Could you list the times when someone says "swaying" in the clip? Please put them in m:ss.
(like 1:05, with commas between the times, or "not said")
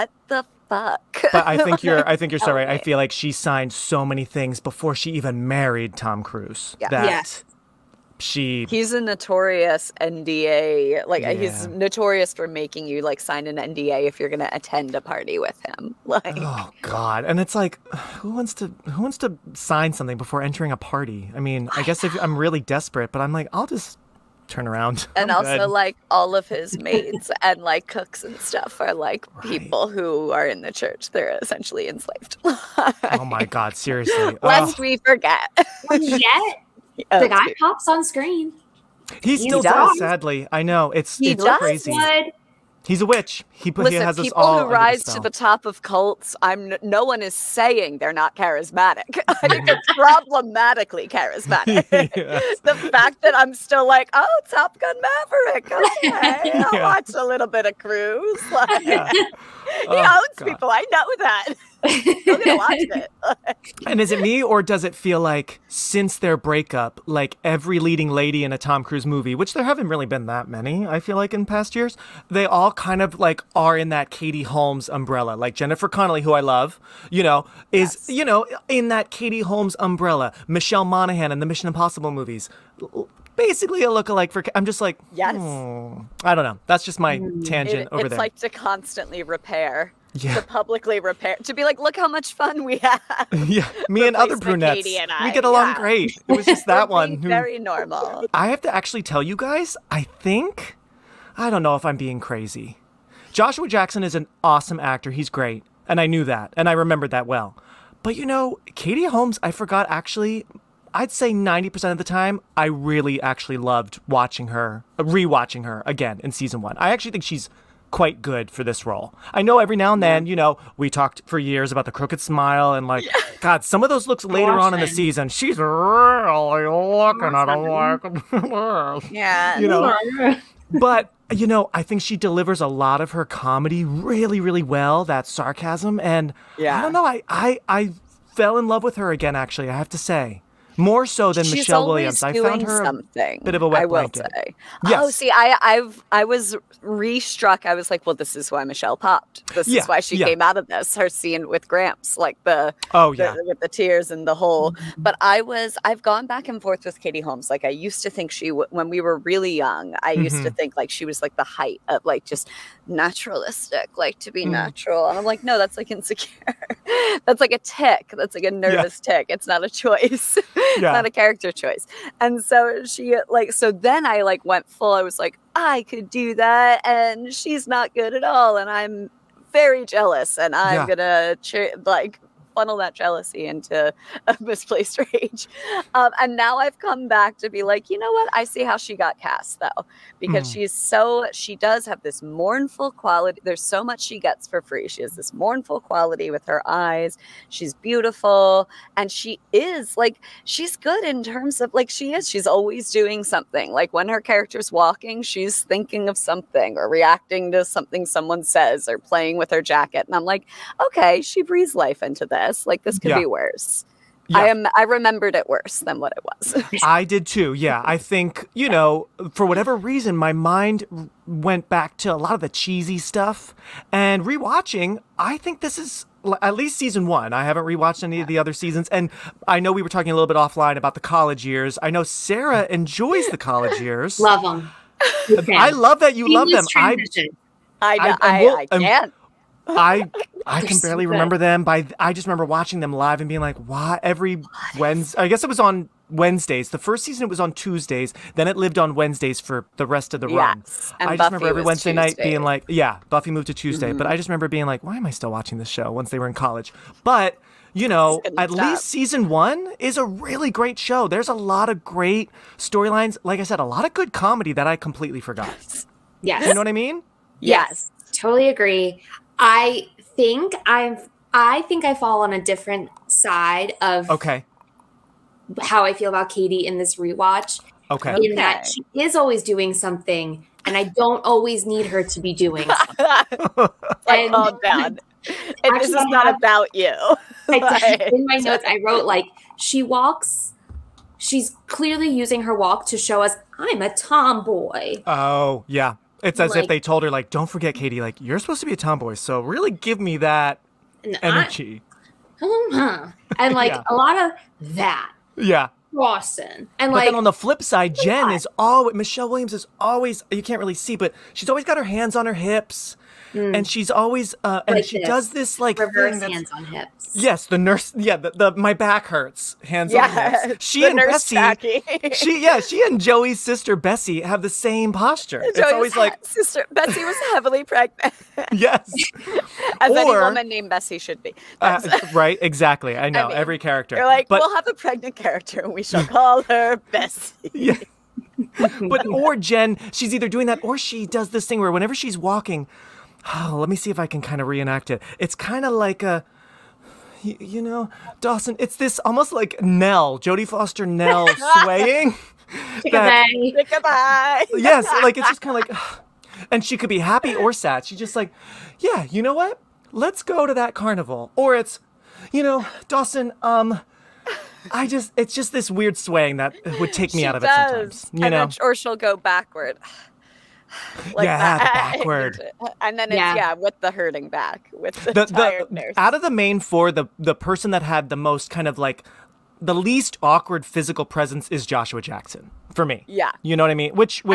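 5:51, 6:05.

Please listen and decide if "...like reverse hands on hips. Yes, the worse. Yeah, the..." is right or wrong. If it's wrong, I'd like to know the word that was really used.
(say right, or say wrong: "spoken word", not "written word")
wrong: "nurse", not "worse".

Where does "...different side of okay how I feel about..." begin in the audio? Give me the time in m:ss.
4:32.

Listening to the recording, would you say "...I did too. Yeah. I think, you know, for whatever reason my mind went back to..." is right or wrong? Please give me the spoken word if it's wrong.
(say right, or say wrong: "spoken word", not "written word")
right.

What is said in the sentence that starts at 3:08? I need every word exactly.
I see how she got cast though, because mm.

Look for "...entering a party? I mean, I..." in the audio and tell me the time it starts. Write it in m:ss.
0:20.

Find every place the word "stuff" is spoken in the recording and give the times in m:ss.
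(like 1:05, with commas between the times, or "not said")
0:28, 3:42.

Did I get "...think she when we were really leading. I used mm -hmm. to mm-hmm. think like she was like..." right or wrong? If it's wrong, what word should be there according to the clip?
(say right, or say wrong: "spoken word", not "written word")
wrong: "young", not "leading".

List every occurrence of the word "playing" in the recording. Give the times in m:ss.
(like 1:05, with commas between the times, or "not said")
3:28.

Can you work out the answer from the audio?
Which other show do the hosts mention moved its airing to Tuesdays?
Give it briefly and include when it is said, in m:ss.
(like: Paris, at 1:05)
Buffy, at 4:13.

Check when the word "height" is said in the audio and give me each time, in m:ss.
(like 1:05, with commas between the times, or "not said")
2:41.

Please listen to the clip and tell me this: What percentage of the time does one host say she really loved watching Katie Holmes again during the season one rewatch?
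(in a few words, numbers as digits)
90%.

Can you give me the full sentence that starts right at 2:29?
This yeah, is why she yeah.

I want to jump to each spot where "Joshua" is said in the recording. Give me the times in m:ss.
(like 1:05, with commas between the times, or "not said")
1:43, 6:21.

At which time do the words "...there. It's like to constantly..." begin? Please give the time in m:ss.
1:28.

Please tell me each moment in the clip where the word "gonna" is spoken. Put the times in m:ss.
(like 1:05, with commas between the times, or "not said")
0:14, 3:01.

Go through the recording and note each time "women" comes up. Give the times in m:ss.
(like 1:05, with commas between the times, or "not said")
not said.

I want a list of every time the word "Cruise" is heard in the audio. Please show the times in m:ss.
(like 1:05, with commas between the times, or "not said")
0:06, 0:57, 1:08.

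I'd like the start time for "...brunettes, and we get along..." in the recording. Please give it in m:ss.
1:34.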